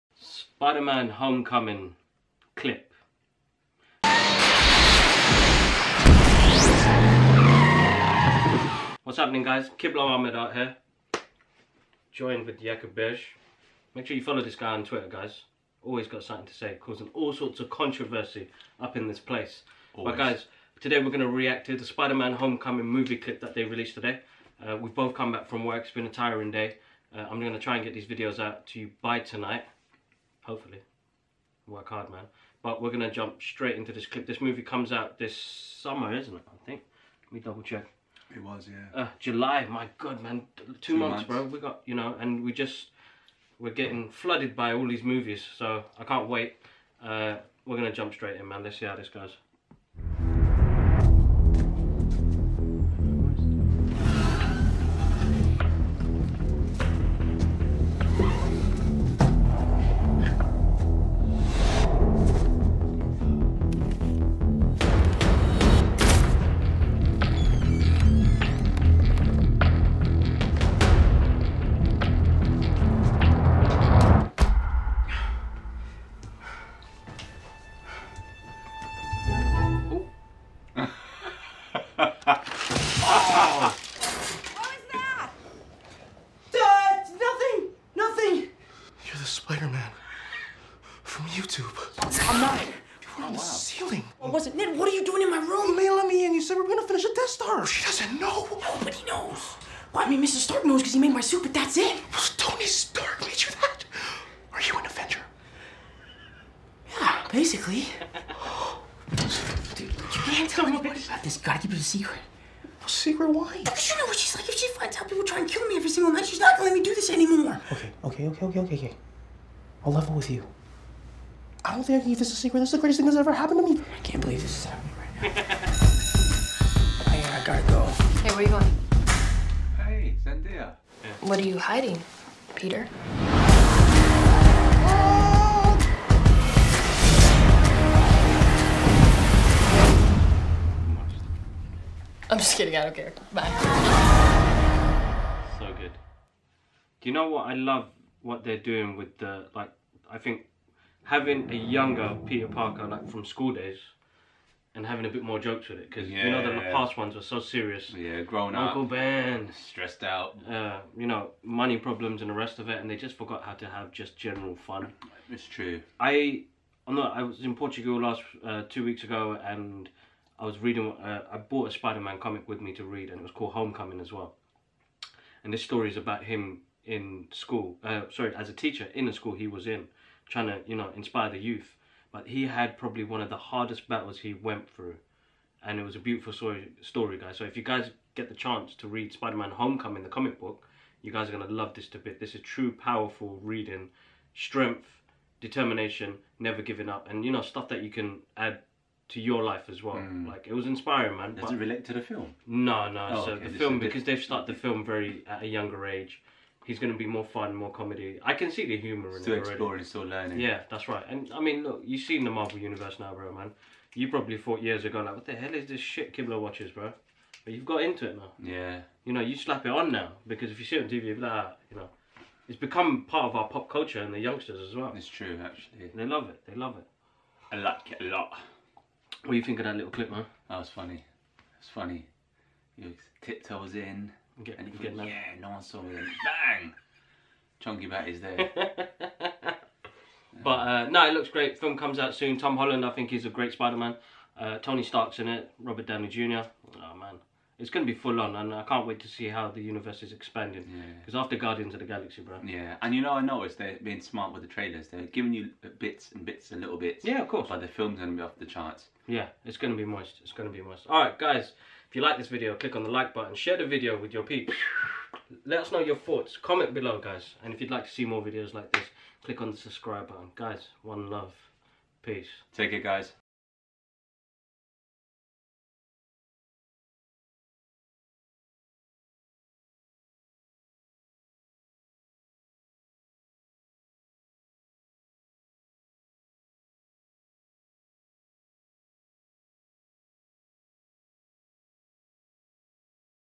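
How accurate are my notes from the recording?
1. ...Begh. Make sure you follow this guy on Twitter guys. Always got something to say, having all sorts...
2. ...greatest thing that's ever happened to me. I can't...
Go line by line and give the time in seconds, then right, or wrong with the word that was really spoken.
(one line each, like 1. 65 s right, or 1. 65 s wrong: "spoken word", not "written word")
1. 12 s wrong: "causing", not "having"
2. 122 s right.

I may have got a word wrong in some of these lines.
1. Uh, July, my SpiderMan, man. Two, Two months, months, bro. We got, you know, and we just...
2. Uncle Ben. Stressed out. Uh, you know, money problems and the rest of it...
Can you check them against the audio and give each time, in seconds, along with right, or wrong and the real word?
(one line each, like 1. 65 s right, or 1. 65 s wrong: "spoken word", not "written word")
1. 39 s wrong: "God", not "SpiderMan"
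2. 158 s right.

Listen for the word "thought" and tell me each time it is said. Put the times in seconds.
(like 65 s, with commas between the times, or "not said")
214 s, 265 s.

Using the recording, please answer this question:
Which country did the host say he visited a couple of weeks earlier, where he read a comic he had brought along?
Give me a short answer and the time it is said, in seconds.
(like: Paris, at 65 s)
Portugal, at 167 s.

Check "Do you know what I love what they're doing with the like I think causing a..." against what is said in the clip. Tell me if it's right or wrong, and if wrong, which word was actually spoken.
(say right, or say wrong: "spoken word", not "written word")
wrong: "having", not "causing".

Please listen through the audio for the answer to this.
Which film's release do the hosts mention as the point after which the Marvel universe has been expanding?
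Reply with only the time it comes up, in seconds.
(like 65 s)
251 s.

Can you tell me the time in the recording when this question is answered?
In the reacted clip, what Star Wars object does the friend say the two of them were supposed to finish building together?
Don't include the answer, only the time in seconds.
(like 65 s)
97 s.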